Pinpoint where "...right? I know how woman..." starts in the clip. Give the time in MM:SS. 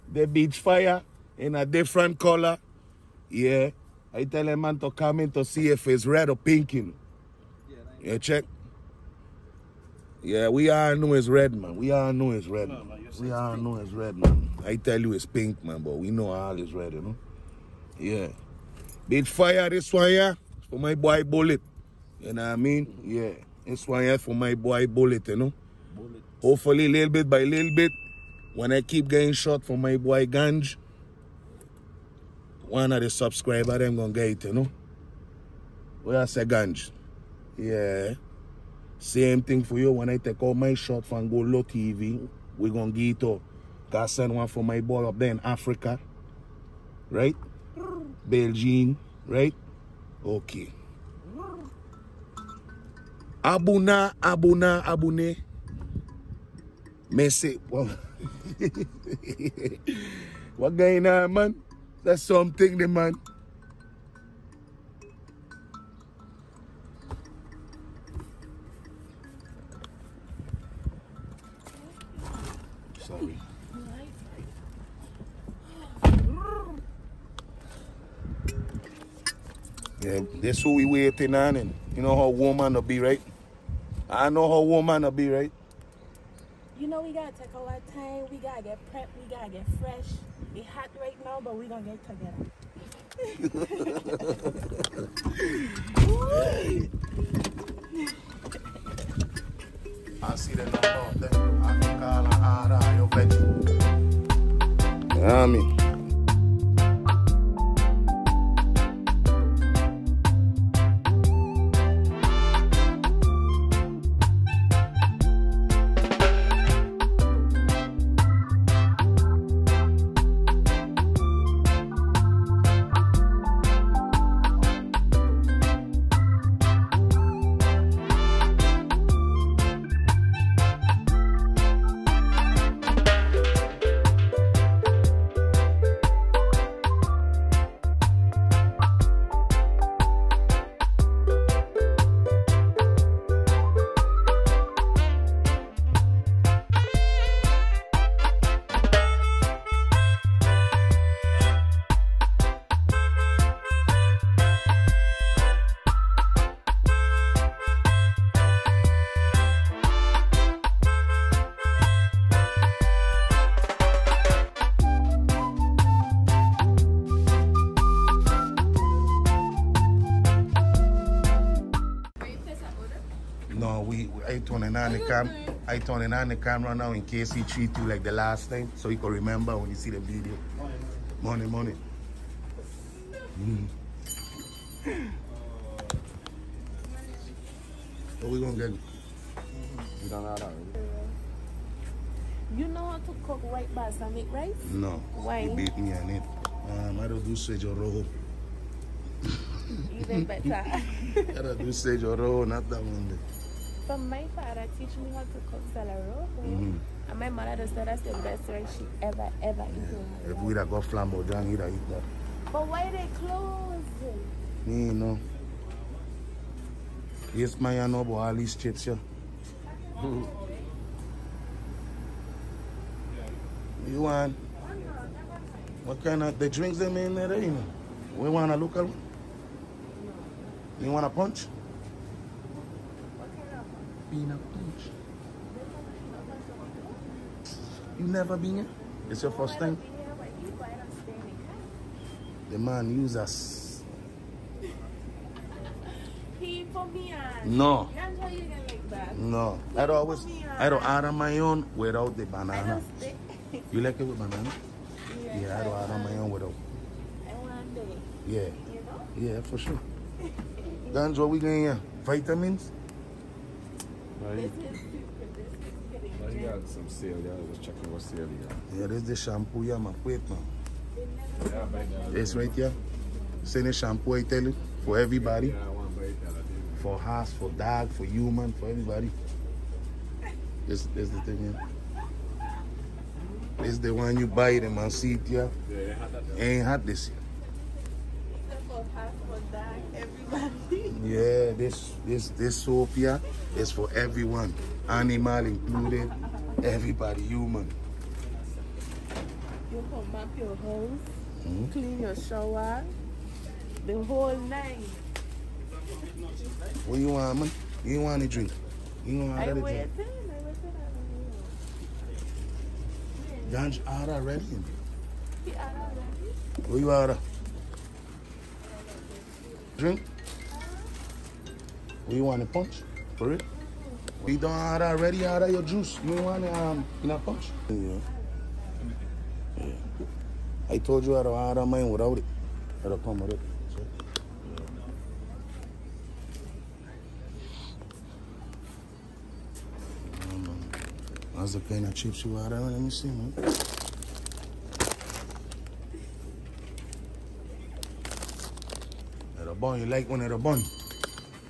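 01:23.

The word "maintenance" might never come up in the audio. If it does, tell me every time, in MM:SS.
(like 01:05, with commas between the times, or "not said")
not said.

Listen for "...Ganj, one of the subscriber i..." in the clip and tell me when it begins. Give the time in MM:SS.
00:30.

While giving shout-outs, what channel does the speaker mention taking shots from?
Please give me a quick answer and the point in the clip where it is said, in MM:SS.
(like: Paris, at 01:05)
Goldo TV, at 00:41.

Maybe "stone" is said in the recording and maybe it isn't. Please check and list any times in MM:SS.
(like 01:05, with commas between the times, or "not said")
not said.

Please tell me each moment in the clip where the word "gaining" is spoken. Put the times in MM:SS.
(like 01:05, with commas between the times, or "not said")
not said.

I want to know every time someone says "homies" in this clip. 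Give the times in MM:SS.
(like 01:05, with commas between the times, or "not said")
not said.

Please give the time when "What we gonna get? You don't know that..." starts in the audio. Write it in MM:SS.
03:08.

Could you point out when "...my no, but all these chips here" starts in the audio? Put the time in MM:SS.
03:37.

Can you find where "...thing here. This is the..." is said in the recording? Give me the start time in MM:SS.
04:41.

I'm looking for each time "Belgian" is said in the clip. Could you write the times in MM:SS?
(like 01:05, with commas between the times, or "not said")
00:48.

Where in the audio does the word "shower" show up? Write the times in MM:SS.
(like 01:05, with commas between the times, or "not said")
05:02.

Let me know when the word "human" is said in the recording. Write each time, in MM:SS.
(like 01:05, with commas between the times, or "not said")
04:38, 04:57.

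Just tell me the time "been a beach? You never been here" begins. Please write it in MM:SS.
03:54.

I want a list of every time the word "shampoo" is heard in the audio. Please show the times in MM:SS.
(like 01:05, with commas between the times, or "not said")
04:29, 04:33.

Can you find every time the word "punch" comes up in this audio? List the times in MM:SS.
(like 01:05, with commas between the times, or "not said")
03:51, 05:22, 05:27.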